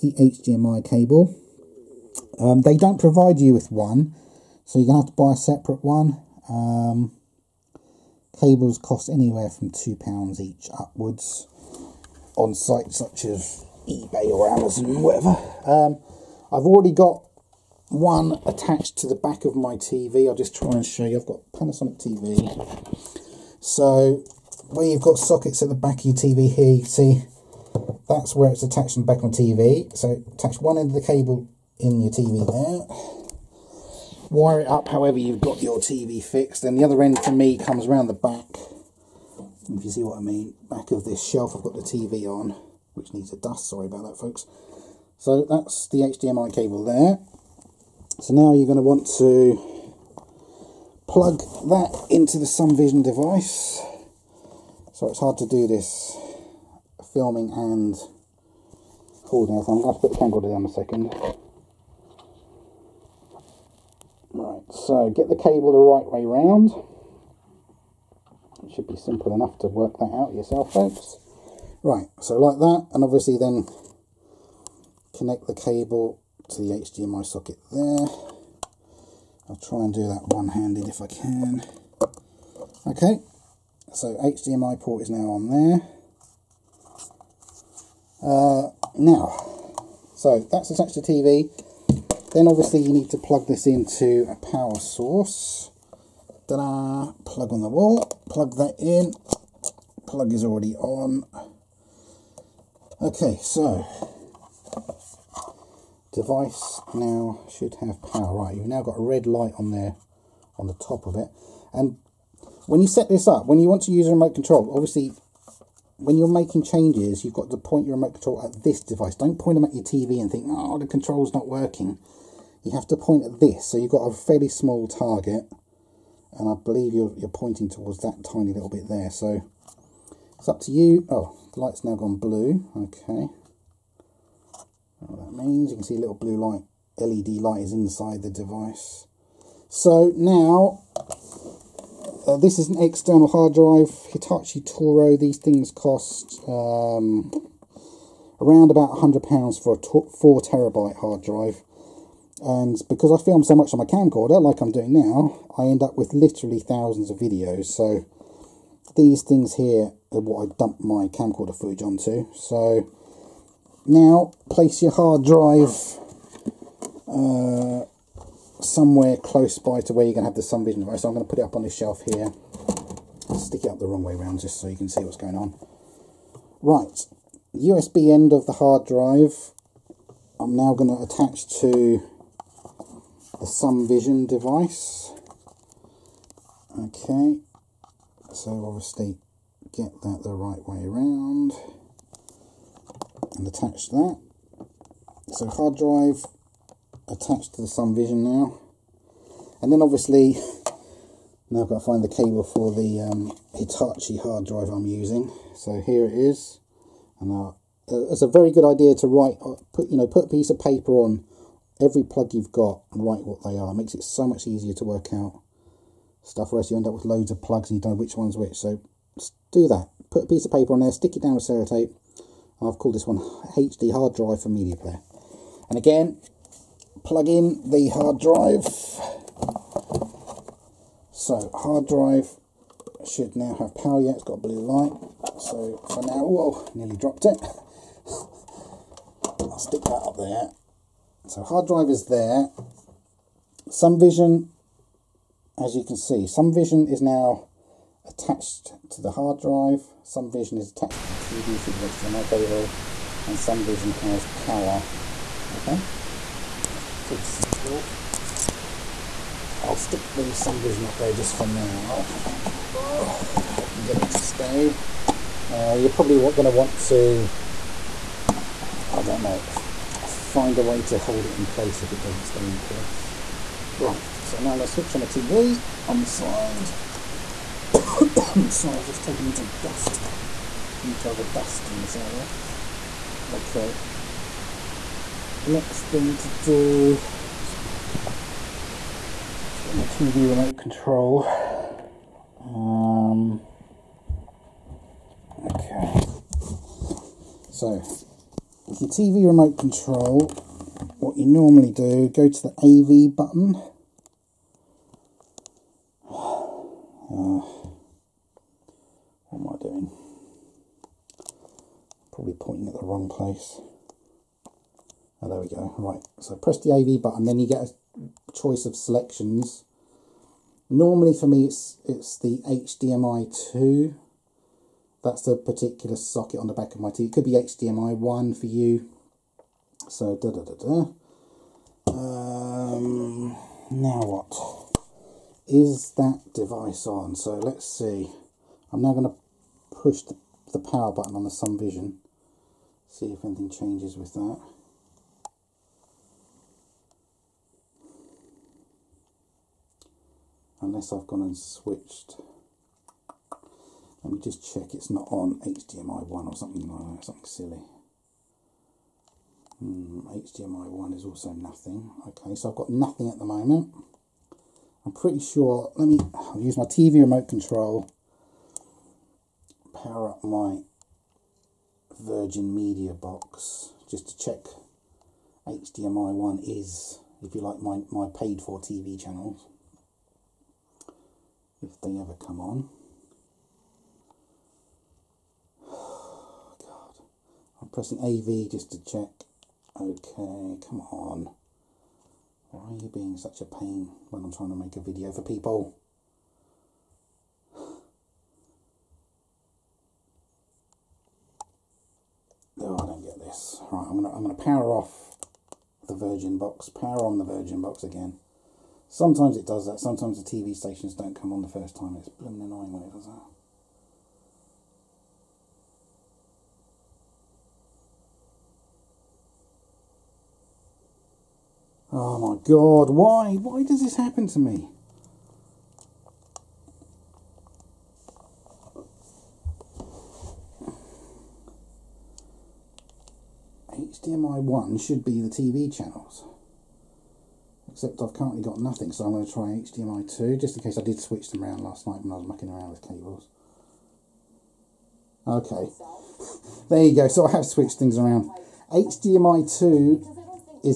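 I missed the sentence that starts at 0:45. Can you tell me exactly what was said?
So that's the HDMI cable there.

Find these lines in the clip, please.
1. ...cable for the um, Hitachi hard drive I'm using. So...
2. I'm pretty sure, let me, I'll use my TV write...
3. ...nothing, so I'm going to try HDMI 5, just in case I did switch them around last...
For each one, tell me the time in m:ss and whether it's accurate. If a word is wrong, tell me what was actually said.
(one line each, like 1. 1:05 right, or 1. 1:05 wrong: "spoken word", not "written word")
1. 3:22 right
2. 6:04 wrong: "remote", not "write"
3. 7:18 wrong: "2", not "5".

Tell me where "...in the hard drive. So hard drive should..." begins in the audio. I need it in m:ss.
3:47.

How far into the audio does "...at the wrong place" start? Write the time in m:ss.
5:12.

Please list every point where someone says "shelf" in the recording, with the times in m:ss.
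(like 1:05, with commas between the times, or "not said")
0:41, 2:51.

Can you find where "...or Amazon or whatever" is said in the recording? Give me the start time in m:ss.
0:14.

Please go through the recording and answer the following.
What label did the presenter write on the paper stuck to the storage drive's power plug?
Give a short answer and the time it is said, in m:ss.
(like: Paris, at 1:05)
HD hard drive for media player, at 3:43.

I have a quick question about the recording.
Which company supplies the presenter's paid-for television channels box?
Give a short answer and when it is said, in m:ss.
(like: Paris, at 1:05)
Virgin Media, at 6:11.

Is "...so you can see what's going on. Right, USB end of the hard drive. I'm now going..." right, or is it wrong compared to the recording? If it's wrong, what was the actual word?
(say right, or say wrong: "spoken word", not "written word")
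right.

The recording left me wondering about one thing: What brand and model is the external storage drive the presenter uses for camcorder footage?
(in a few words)
Hitachi Touro.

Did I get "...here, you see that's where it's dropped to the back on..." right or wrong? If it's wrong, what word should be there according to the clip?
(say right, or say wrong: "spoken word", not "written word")
wrong: "attached", not "dropped".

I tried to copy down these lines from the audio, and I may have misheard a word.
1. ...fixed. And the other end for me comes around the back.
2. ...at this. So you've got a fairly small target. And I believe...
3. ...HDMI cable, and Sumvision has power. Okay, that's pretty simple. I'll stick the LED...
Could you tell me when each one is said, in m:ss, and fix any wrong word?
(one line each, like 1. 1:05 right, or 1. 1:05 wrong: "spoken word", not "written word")
1. 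0:36 right
2. 2:03 right
3. 4:11 wrong: "Sumvision", not "LED".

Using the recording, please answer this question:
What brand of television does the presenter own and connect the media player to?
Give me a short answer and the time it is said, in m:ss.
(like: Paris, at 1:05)
Panasonic, at 0:21.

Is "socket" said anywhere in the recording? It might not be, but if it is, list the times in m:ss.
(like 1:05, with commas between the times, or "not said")
0:25, 1:17, 5:25.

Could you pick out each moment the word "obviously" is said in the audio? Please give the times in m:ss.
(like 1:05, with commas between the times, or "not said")
1:13, 1:32, 1:54, 3:08, 3:19.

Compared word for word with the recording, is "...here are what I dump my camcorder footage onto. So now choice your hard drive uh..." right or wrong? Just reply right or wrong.
wrong.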